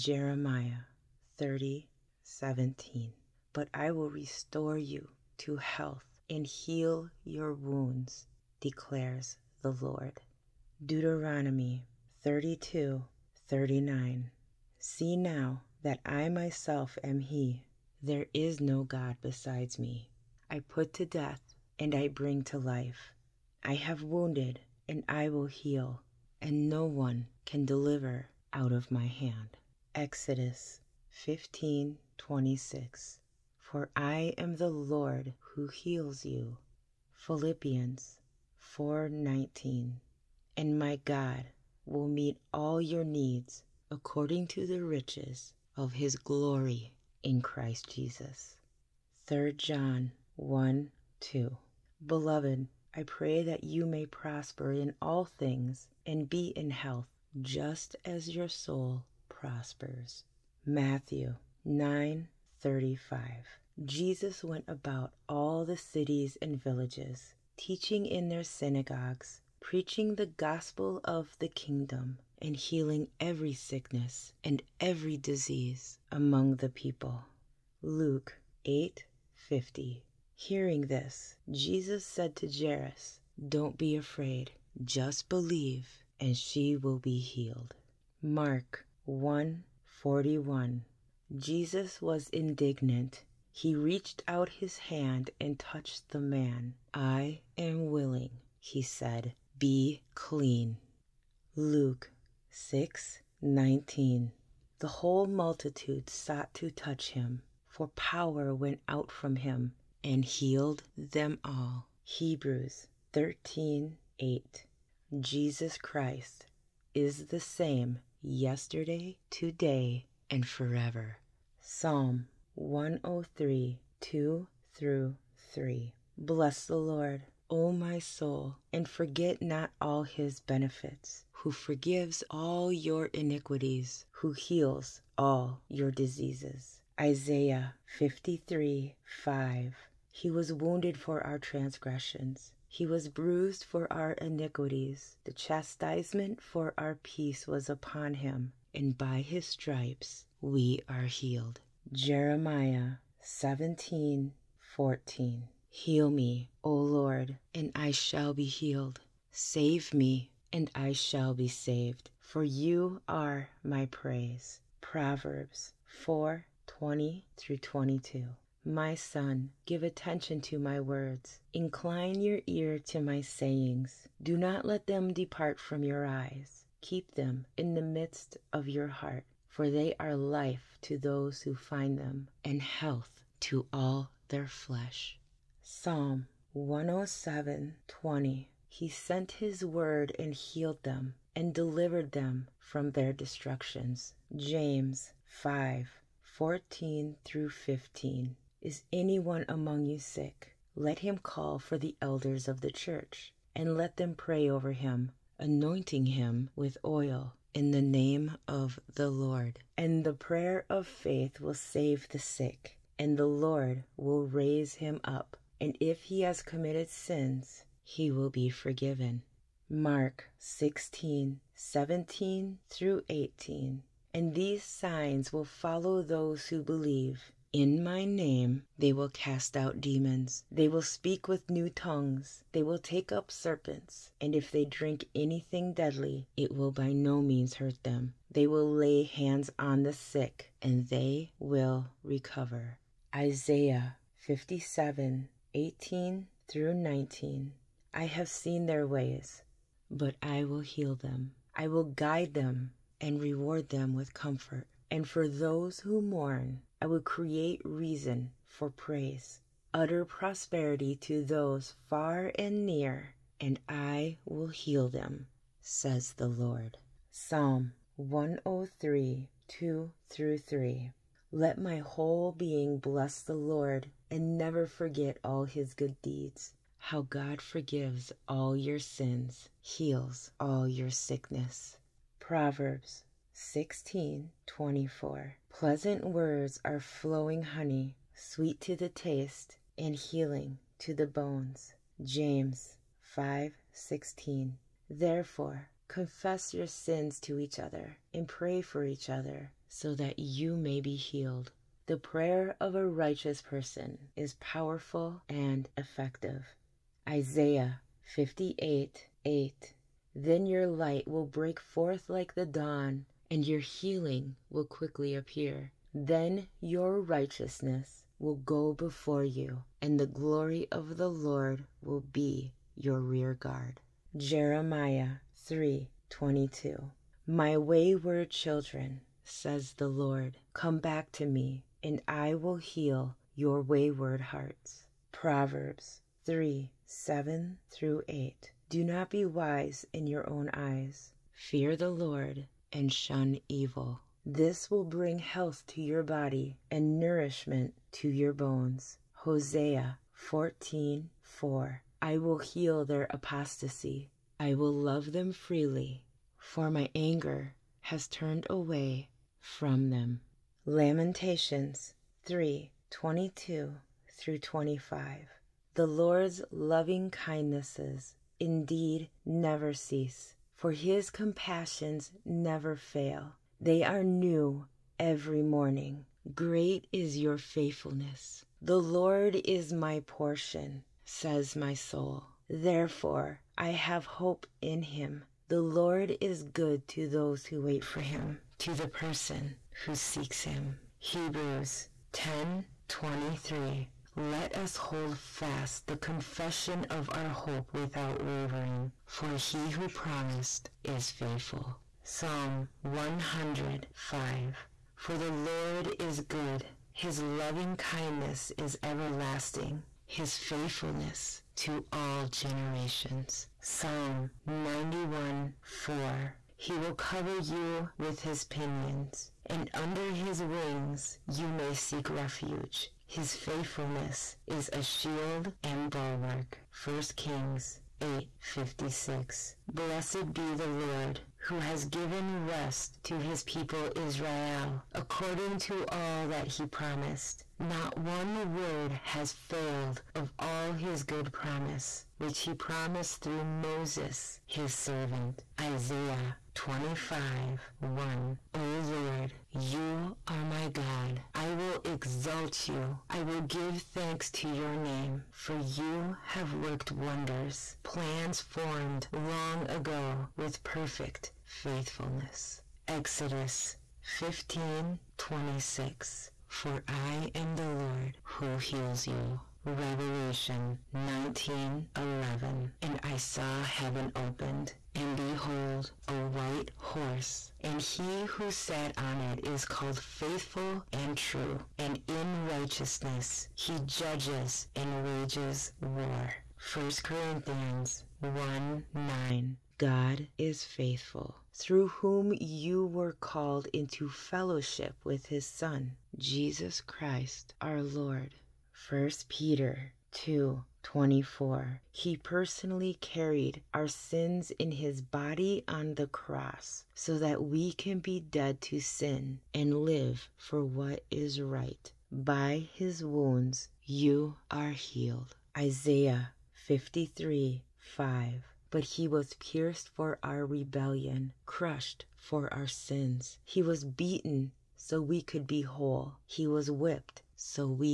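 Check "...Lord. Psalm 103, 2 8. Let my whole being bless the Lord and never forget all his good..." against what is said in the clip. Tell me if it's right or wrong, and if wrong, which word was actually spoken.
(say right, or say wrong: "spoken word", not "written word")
wrong: "3", not "8".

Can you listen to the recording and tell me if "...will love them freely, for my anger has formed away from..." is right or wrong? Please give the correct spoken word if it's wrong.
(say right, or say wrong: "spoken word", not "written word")
wrong: "turned", not "formed".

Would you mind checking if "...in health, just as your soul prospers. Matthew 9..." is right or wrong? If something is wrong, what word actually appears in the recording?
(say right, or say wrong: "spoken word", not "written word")
right.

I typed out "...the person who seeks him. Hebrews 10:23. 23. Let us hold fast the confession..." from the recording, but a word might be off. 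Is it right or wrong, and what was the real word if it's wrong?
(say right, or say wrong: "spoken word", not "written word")
right.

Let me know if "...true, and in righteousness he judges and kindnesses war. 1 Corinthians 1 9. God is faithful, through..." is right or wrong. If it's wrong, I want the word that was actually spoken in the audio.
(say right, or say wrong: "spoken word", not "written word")
wrong: "wages", not "kindnesses".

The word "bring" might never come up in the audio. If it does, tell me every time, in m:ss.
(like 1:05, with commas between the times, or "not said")
0:22, 5:44.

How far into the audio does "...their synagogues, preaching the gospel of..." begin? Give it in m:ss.
1:08.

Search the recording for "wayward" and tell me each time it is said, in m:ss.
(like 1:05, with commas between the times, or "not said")
5:27, 5:33.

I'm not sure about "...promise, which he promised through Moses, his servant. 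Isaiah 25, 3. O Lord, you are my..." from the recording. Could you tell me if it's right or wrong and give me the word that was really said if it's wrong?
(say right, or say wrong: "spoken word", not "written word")
wrong: "1", not "3".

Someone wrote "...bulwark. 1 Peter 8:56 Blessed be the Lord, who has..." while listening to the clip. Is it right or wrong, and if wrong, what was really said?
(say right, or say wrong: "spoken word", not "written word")
wrong: "Kings", not "Peter".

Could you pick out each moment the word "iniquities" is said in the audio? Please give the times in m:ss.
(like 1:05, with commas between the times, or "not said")
2:13, 2:24.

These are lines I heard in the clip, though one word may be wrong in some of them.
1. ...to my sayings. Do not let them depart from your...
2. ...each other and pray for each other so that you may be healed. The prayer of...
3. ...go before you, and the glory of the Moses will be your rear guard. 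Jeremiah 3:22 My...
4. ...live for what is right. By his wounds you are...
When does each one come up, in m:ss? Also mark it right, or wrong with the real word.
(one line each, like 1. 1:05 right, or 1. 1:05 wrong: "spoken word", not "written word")
1. 2:52 right
2. 4:57 right
3. 5:18 wrong: "Lord", not "Moses"
4. 8:29 right.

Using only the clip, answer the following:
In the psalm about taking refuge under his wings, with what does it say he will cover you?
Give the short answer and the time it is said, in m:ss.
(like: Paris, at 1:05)
his pinions, at 6:58.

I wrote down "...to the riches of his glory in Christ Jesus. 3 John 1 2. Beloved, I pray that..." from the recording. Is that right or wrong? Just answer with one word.
right.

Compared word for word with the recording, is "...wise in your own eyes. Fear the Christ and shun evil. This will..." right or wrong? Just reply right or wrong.
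wrong.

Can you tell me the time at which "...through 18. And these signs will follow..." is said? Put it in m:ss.
3:42.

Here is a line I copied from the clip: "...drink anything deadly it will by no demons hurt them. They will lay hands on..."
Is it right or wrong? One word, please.
wrong.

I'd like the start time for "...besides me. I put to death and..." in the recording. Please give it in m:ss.
0:19.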